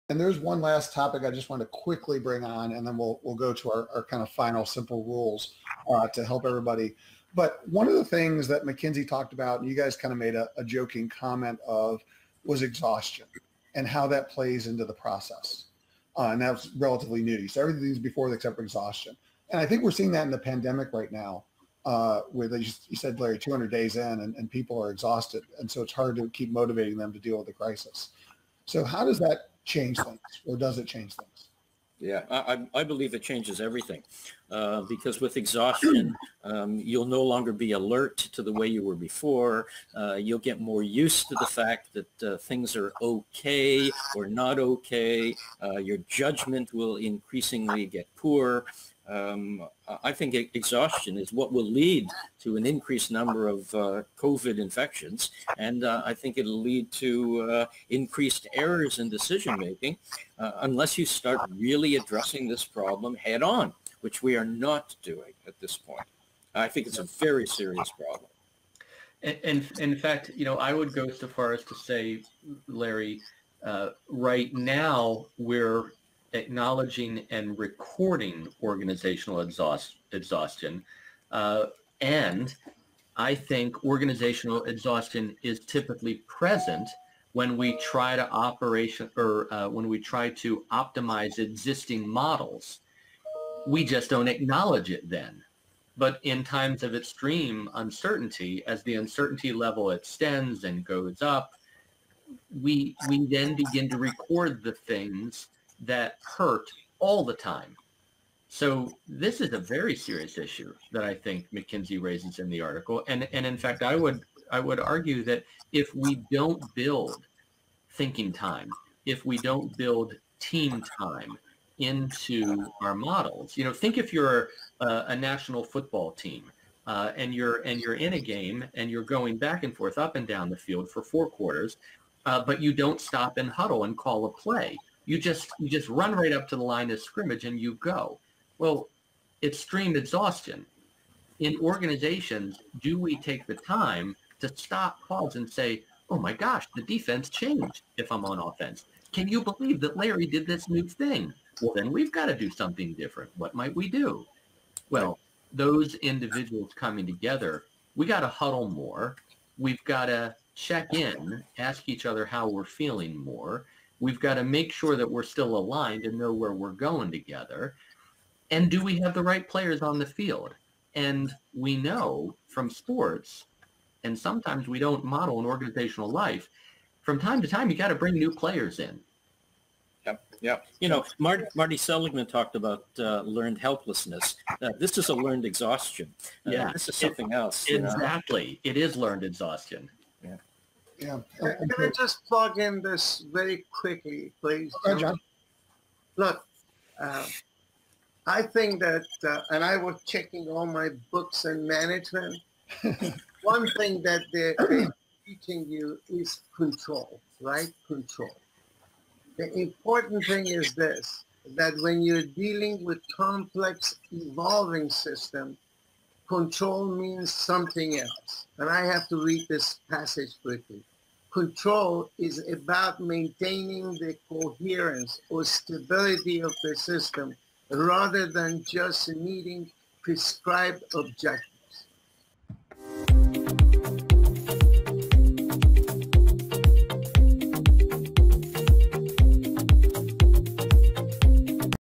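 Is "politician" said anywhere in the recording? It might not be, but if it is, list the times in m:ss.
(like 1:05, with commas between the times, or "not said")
not said.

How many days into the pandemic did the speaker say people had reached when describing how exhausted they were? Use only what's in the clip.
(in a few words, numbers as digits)
200.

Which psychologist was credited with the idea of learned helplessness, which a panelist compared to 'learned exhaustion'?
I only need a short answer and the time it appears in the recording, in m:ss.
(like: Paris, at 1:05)
Marty Seligman, at 3:01.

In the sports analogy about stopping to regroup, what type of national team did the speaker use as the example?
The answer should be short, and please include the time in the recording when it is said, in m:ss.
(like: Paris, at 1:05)
football team, at 2:05.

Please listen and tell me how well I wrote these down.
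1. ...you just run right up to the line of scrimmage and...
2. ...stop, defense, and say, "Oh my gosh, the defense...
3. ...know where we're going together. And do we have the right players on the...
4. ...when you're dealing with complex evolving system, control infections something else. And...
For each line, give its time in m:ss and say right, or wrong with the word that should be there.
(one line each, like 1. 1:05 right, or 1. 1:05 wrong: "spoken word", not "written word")
1. 2:15 right
2. 2:24 wrong: "pause", not "defense"
3. 2:46 right
4. 3:31 wrong: "means", not "infections".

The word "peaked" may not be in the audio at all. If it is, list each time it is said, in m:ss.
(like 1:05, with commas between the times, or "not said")
not said.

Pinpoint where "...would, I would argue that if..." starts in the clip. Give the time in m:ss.
1:53.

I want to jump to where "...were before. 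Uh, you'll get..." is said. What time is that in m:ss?
0:38.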